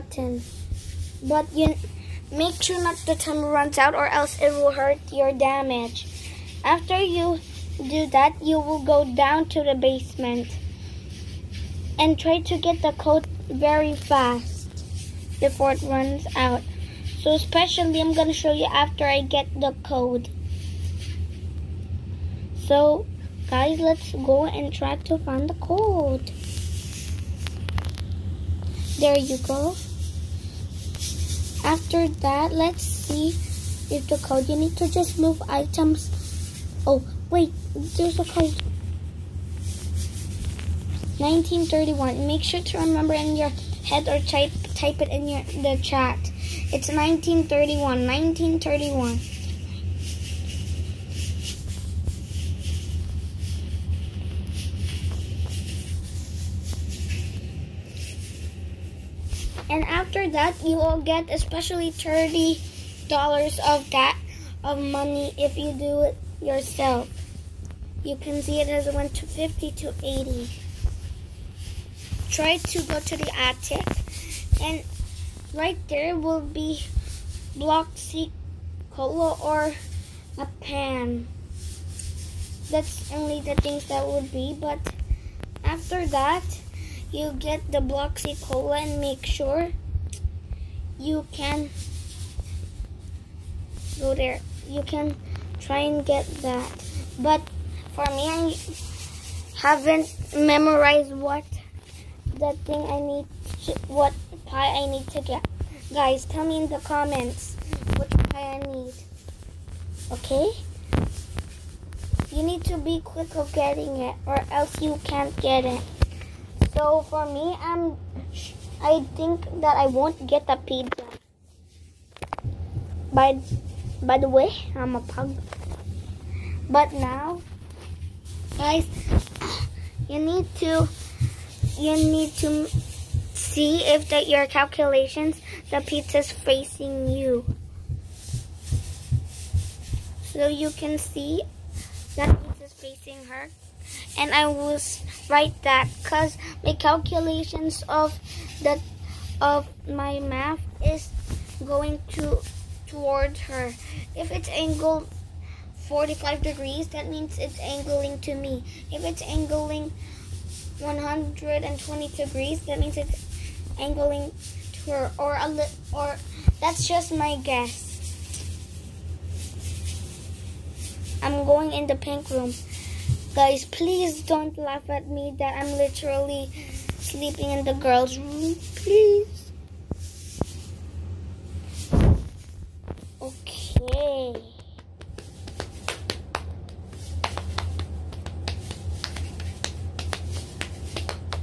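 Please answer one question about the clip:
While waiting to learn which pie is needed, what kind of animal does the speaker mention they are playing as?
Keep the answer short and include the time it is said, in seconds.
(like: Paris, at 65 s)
pug, at 125 s.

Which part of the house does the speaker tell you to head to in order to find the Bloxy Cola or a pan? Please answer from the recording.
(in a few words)
attic.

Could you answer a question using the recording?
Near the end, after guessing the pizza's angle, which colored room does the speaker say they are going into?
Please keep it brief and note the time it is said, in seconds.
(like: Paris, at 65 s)
pink room, at 171 s.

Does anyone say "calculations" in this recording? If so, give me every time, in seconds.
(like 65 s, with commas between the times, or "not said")
134 s, 146 s.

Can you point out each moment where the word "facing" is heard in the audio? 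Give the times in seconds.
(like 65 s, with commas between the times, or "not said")
136 s, 142 s.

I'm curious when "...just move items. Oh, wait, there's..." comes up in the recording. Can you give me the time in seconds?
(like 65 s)
34 s.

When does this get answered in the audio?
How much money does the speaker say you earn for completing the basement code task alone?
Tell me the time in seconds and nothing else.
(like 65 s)
61 s.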